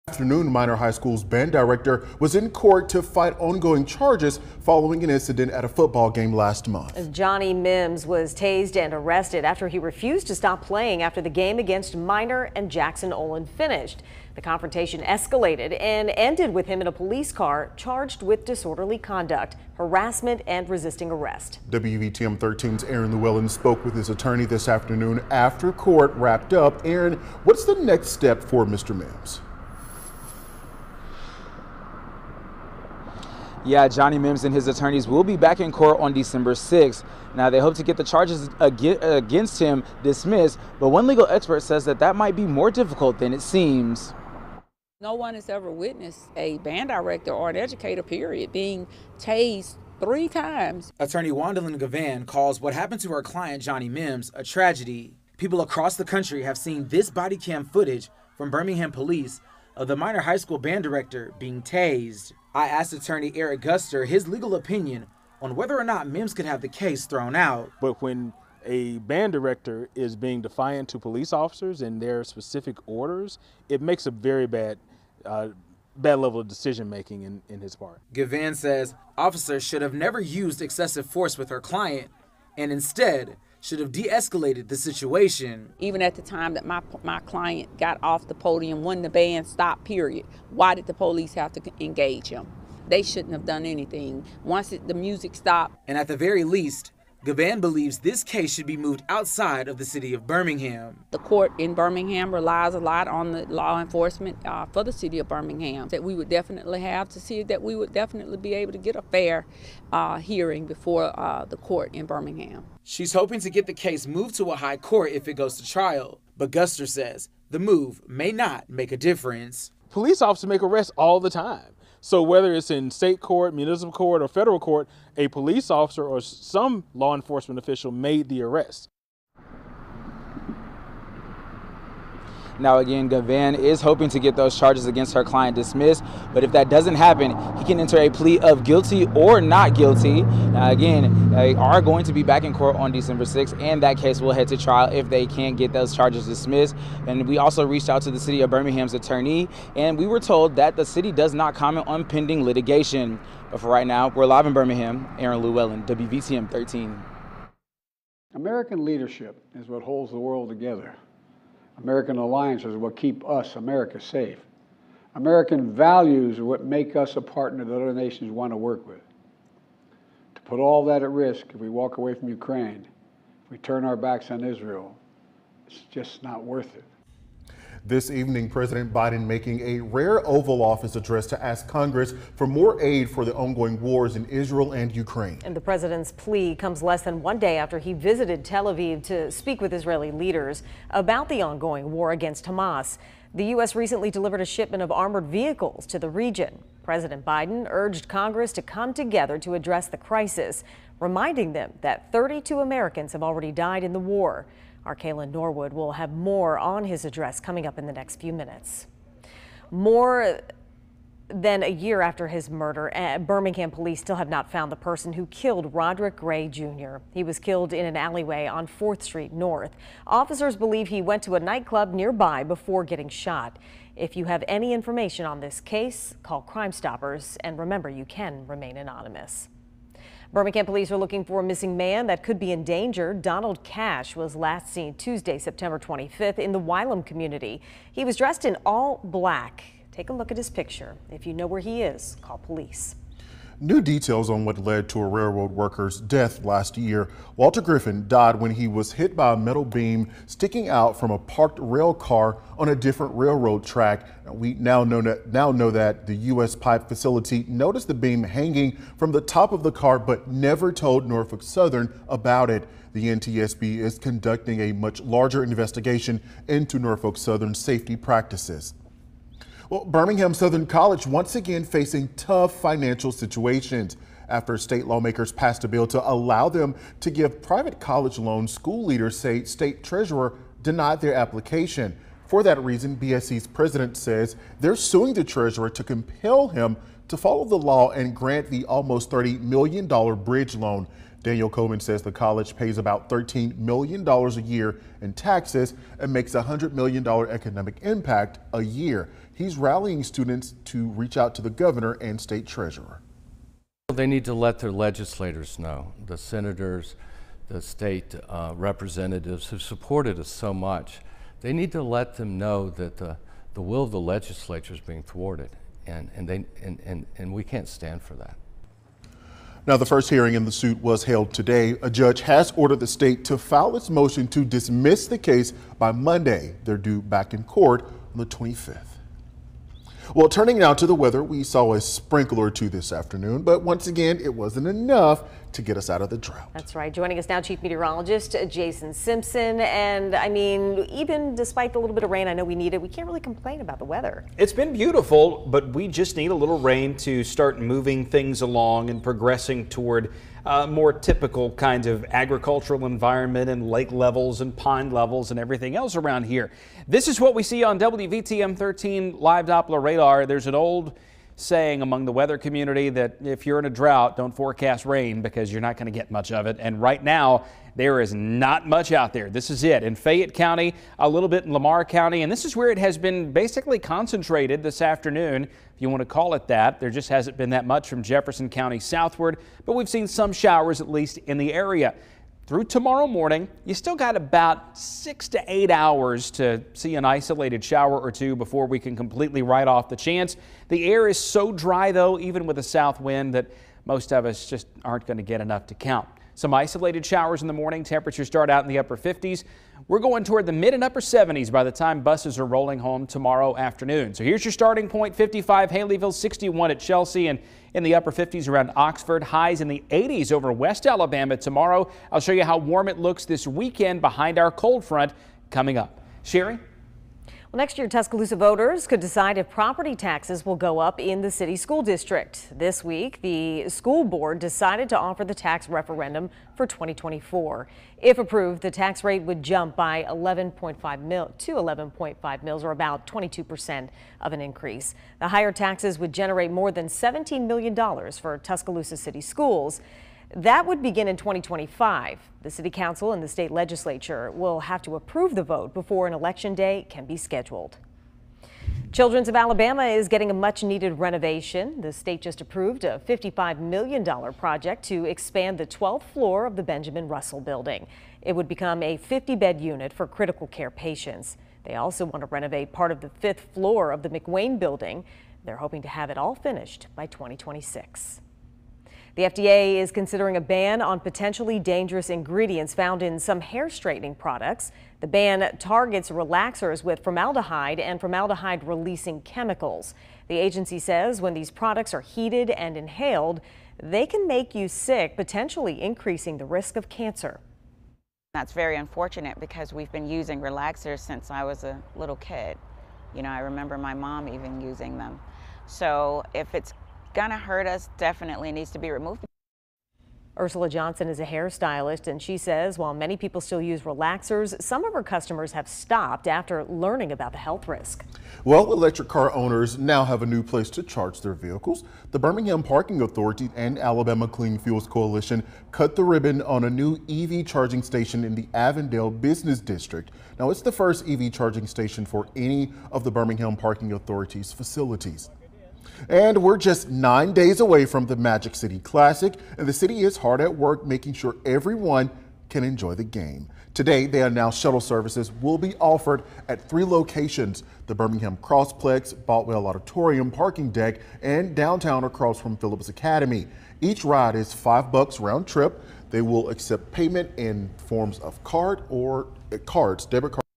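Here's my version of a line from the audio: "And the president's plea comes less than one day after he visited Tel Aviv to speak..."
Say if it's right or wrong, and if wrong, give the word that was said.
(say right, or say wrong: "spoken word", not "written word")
right.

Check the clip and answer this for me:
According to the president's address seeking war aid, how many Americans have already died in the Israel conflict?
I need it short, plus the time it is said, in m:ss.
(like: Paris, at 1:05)
32, at 3:22.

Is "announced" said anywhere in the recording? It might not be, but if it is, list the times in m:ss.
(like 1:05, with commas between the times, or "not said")
8:54.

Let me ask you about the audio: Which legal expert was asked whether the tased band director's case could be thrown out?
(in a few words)
Eric Guster.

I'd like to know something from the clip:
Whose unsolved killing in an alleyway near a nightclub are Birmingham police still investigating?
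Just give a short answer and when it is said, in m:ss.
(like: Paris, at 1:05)
Roderick Gray Jr., at 3:35.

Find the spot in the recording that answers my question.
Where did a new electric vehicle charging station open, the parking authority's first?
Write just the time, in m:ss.
8:38.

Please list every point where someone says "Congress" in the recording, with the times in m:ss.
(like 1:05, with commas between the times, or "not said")
3:01, 3:18.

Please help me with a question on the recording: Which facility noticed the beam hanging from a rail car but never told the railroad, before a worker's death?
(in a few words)
U.S. Pipe.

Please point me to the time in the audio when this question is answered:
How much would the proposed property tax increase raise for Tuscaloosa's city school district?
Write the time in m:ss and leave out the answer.
7:16.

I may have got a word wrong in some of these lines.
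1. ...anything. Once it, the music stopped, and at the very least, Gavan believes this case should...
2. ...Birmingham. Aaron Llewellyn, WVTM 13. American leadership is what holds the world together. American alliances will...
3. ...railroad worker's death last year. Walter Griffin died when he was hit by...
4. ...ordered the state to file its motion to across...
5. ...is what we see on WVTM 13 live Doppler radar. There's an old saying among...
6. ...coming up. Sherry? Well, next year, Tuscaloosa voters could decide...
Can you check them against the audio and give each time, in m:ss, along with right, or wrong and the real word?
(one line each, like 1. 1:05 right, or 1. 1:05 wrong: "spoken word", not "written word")
1. 1:33 right
2. 2:34 right
3. 4:05 right
4. 5:22 wrong: "dismiss", not "across"
5. 5:57 right
6. 6:55 right.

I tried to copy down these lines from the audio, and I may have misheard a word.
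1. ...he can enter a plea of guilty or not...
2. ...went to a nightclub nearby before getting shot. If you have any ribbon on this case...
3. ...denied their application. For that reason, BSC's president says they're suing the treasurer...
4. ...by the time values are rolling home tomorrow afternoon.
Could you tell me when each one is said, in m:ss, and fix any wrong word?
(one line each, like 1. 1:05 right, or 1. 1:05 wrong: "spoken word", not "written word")
1. 2:17 right
2. 3:41 wrong: "information", not "ribbon"
3. 4:40 right
4. 6:41 wrong: "buses", not "values".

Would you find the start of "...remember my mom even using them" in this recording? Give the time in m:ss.
8:13.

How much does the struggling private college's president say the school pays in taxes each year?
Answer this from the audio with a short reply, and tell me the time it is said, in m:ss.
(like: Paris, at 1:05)
$13 million, at 4:53.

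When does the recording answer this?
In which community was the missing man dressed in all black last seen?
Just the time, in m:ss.
3:56.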